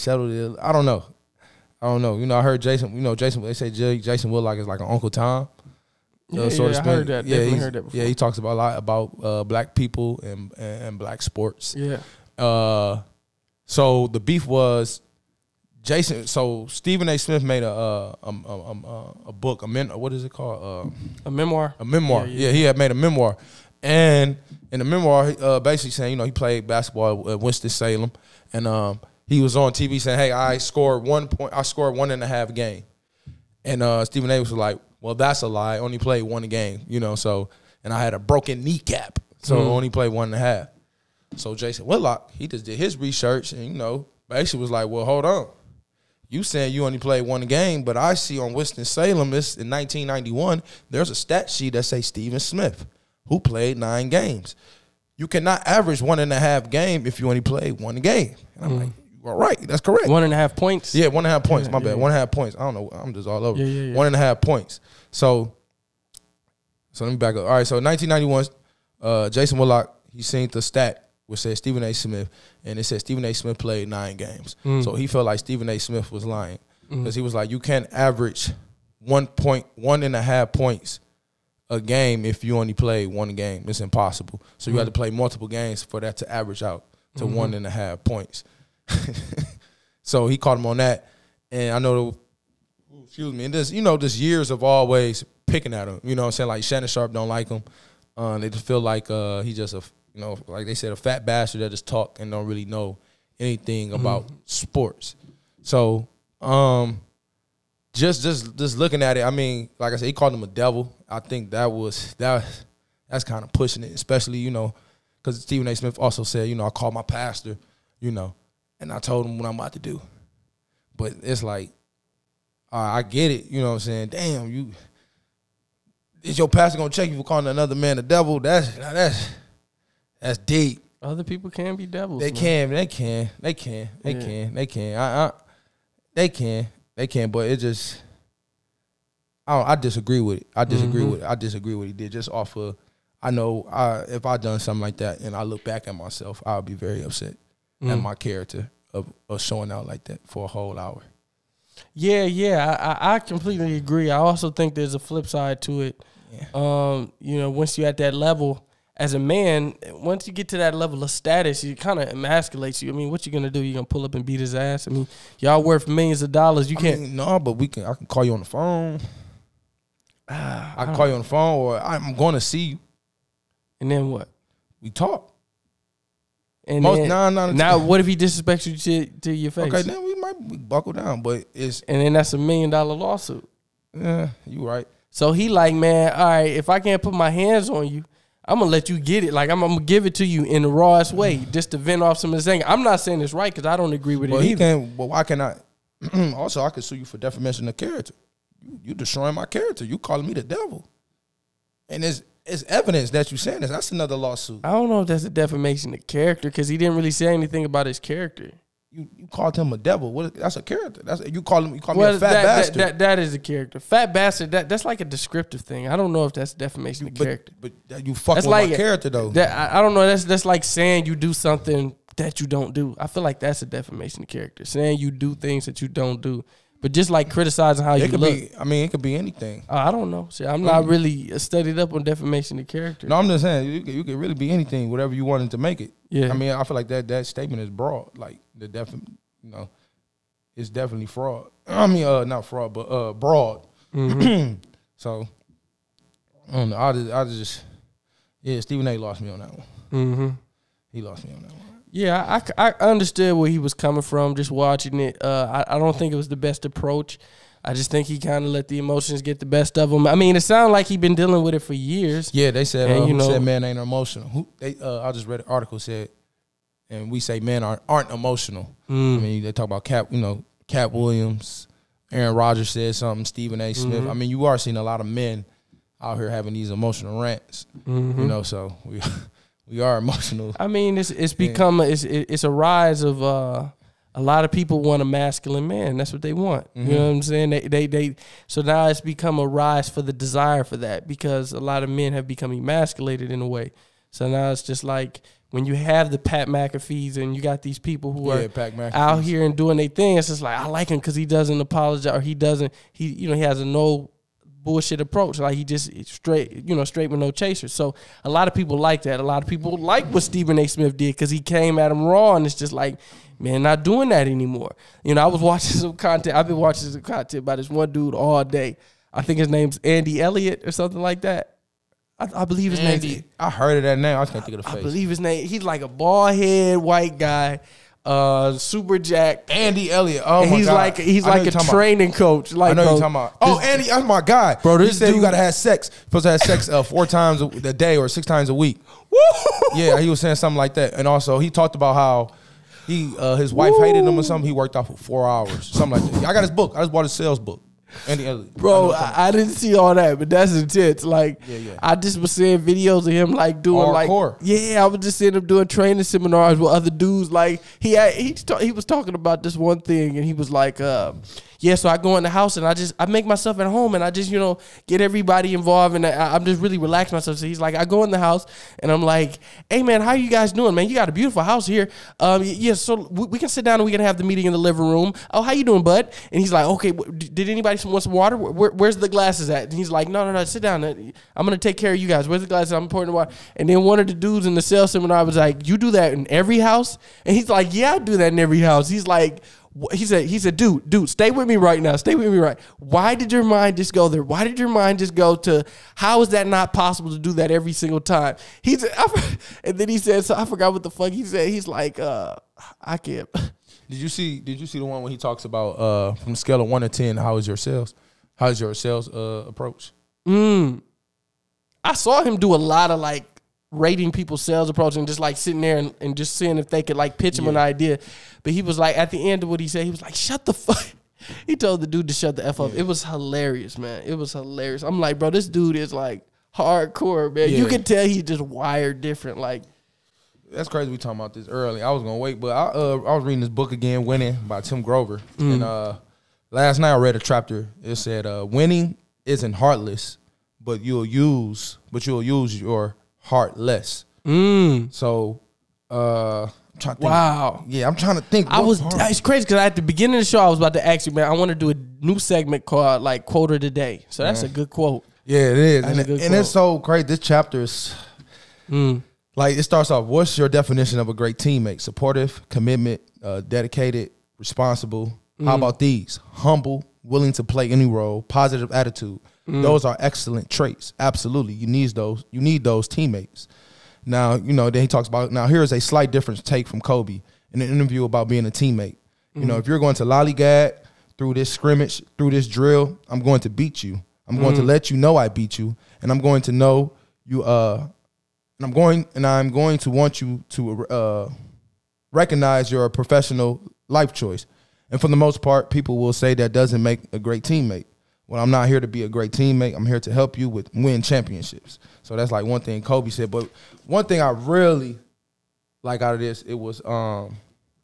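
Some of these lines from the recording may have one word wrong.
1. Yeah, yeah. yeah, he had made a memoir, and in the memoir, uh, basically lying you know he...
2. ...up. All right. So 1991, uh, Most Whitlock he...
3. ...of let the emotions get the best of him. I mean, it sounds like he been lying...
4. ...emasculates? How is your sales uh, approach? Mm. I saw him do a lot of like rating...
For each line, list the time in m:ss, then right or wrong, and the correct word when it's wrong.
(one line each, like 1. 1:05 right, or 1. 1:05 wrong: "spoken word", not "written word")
1. 0:22 wrong: "saying", not "lying"
2. 1:07 wrong: "Jason", not "Most"
3. 4:18 wrong: "dealing", not "lying"
4. 6:47 wrong: "sales", not "emasculates".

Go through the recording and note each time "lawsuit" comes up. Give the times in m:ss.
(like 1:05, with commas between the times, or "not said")
3:02, 3:24.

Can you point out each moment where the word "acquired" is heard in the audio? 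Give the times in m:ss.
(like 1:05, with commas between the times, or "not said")
not said.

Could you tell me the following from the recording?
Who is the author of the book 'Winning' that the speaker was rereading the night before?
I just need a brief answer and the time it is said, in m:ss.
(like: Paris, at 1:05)
Tim Grover, at 7:14.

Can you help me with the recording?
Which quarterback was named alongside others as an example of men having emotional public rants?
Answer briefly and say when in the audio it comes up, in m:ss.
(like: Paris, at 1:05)
Aaron Rodgers, at 4:32.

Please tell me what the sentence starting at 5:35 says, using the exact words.
You're supposed to have sex uh, four times a, a day or six times a week.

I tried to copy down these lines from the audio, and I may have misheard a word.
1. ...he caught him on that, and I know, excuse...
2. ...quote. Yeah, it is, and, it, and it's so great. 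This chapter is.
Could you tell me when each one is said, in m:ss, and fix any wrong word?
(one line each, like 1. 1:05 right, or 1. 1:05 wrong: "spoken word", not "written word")
1. 1:30 right
2. 7:34 right.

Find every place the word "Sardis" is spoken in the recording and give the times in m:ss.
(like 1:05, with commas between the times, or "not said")
not said.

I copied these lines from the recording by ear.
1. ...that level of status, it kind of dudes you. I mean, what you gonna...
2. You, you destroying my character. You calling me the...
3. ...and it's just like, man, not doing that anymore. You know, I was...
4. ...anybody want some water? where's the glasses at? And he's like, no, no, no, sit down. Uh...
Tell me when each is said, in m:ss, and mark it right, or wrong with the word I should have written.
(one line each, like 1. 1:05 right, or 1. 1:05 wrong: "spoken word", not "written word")
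1. 2:40 wrong: "emasculates", not "dudes"
2. 3:18 right
3. 5:12 right
4. 6:17 right.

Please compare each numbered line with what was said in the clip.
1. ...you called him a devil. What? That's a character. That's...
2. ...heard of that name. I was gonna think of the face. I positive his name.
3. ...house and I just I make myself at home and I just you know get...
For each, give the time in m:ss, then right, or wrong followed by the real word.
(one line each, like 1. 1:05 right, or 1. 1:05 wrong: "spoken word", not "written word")
1. 3:29 right
2. 5:23 wrong: "believe", not "positive"
3. 6:02 right.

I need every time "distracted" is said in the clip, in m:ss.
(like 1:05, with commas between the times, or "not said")
not said.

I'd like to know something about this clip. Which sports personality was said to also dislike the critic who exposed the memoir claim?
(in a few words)
Shannon Sharpe.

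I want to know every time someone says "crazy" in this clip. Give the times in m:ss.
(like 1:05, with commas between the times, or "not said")
7:10, 7:29.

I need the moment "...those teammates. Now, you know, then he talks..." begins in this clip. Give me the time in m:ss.
7:52.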